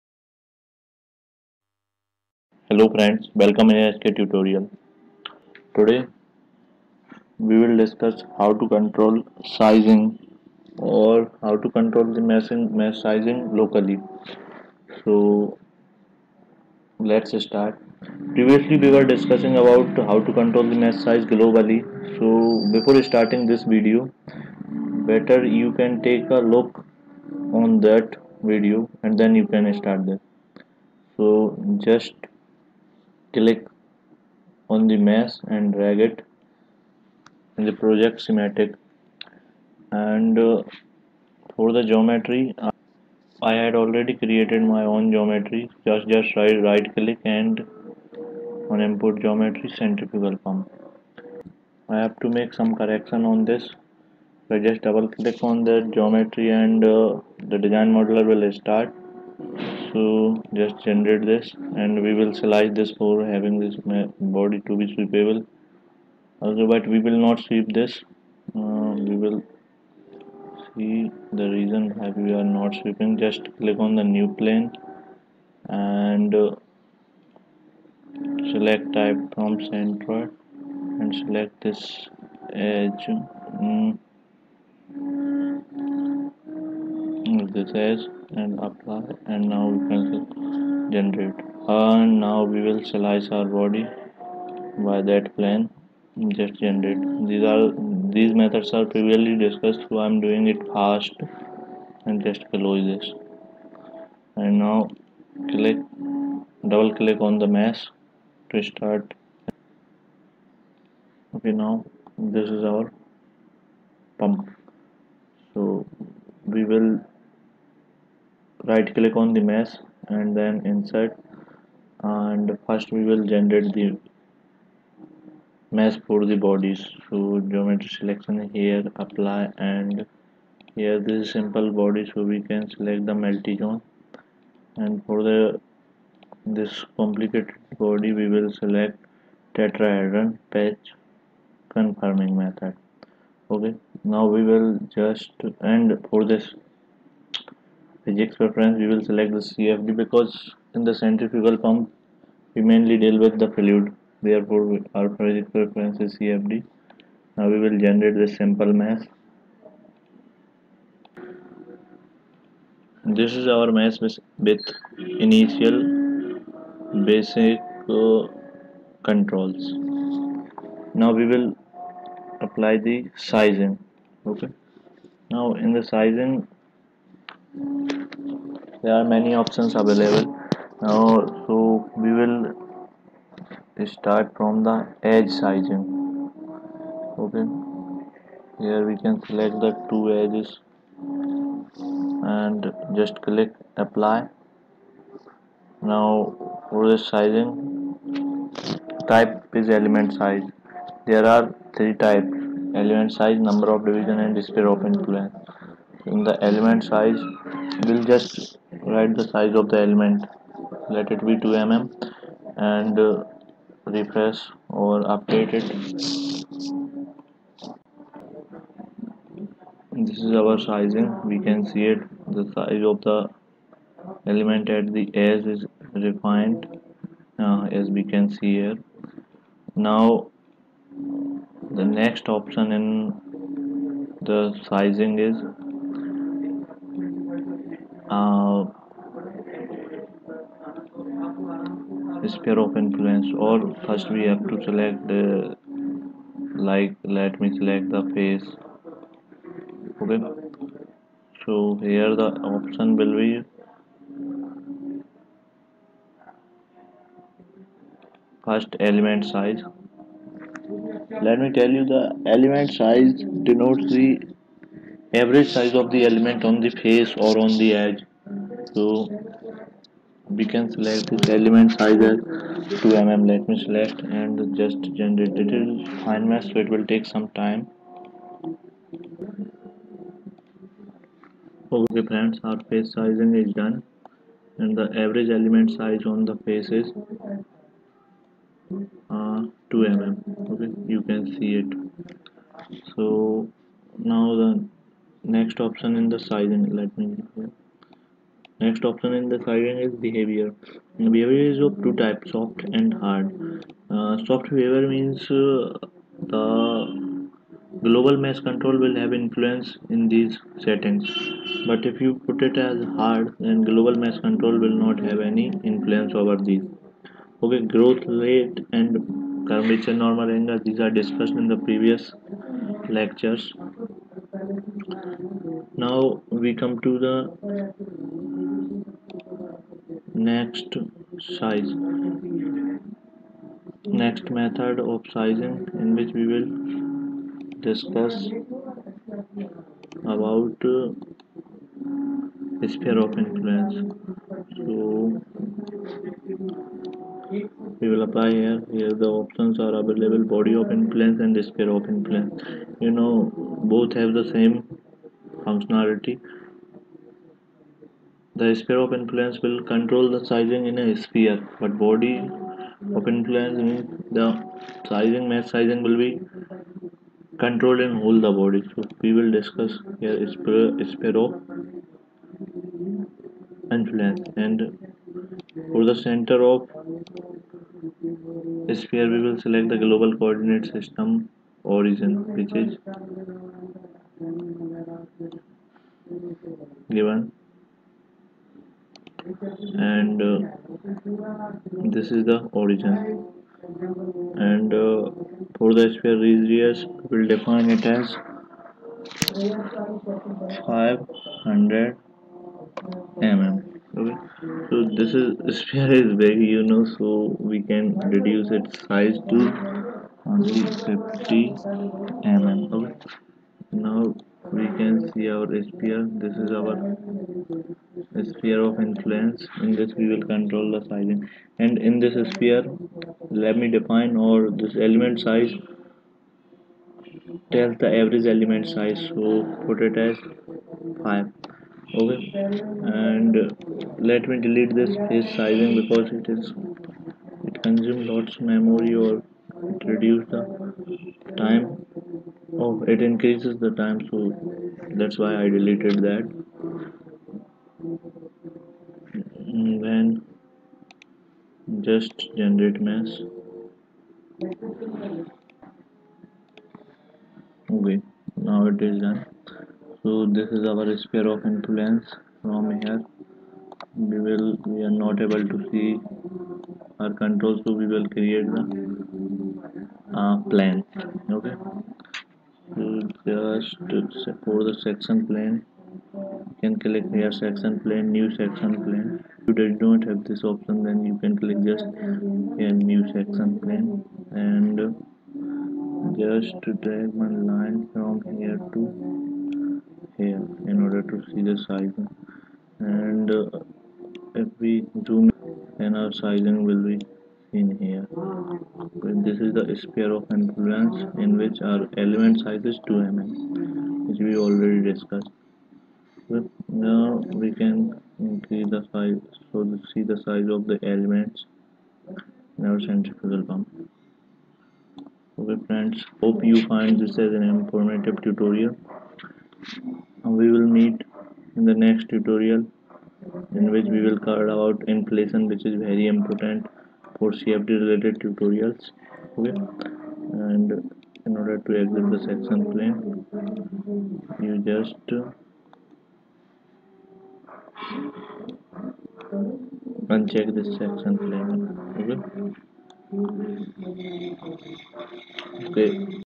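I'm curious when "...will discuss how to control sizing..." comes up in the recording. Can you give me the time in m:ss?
0:07.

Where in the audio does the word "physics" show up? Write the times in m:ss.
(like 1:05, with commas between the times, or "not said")
2:28, 2:35.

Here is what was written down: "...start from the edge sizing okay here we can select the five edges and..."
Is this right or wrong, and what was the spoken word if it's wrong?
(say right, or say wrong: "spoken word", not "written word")
wrong: "two", not "five".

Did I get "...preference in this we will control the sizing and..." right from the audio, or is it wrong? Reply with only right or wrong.
wrong.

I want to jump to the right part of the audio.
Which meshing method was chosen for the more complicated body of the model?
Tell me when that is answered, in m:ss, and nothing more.
2:19.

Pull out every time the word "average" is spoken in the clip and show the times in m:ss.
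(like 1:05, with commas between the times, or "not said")
4:25, 4:45, 7:08.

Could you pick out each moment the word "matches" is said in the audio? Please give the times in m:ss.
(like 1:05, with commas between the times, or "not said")
not said.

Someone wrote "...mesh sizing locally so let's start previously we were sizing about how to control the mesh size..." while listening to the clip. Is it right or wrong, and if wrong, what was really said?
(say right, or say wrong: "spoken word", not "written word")
wrong: "discussing", not "sizing".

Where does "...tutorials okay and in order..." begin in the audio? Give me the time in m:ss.
8:48.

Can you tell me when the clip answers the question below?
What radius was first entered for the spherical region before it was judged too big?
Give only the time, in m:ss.
6:39.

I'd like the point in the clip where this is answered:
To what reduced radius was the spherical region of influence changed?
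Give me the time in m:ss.
6:50.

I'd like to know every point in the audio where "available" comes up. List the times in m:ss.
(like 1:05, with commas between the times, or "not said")
2:59, 5:49.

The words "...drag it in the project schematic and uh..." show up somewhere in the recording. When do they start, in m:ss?
0:35.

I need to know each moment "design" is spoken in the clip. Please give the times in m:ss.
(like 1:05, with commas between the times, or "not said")
0:57.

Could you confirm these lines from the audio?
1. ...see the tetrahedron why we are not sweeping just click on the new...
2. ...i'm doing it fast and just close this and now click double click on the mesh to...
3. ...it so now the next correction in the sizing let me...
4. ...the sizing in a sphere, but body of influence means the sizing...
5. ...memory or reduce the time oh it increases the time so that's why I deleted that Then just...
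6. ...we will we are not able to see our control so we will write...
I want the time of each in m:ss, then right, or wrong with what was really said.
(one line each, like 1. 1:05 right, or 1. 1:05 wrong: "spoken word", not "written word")
1. 1:10 wrong: "reason", not "tetrahedron"
2. 1:40 right
3. 4:51 wrong: "option", not "correction"
4. 6:00 right
5. 7:18 right
6. 7:44 wrong: "create", not "write".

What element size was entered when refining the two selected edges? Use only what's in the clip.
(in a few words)
2 mm.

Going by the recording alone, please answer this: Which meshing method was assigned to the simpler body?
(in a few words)
Multi zone.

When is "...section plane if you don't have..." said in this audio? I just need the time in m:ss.
7:58.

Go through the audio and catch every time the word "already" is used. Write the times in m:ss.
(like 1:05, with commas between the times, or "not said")
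0:43, 8:24.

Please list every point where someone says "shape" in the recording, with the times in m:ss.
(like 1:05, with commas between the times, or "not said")
not said.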